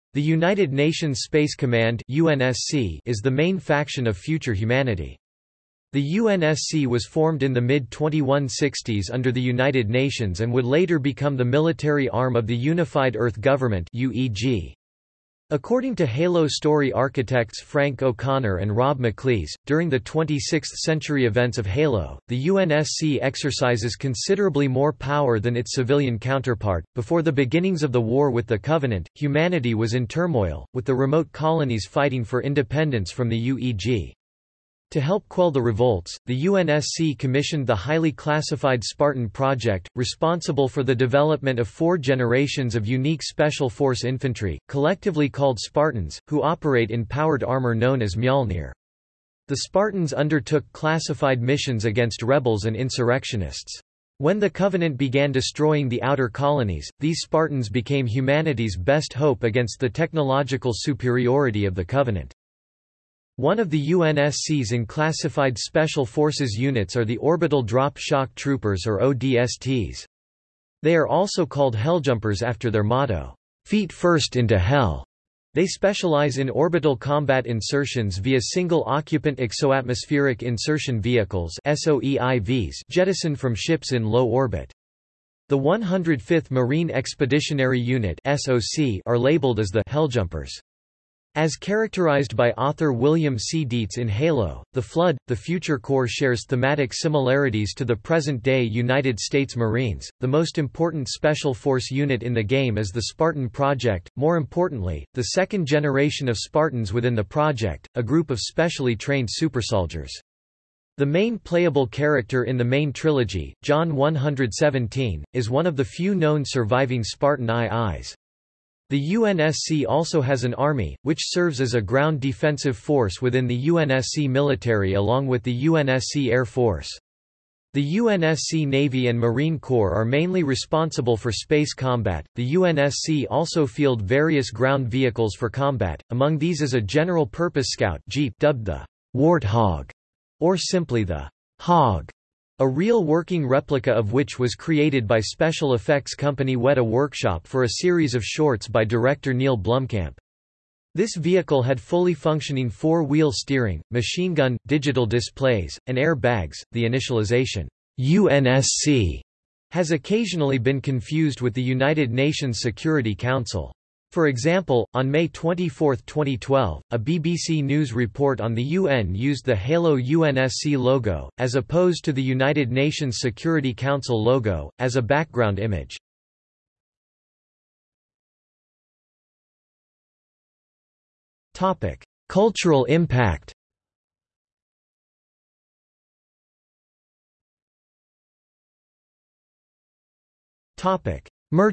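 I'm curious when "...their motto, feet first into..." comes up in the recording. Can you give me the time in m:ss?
1:12.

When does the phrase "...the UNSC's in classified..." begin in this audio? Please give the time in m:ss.
1:03.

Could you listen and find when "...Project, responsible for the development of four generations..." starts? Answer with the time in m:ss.
0:39.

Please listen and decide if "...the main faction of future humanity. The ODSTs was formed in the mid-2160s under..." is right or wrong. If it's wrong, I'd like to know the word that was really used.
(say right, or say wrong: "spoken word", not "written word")
wrong: "UNSC", not "ODSTs".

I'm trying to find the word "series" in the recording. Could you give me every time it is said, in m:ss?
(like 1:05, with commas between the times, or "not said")
2:27.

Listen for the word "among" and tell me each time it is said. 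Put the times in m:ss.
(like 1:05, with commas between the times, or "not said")
2:16.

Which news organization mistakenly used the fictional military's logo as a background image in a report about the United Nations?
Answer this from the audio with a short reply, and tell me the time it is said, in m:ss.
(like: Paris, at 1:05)
BBC News, at 2:47.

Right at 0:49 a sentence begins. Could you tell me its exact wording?
The Spartans undertook classified missions against rebels and insurrectionists.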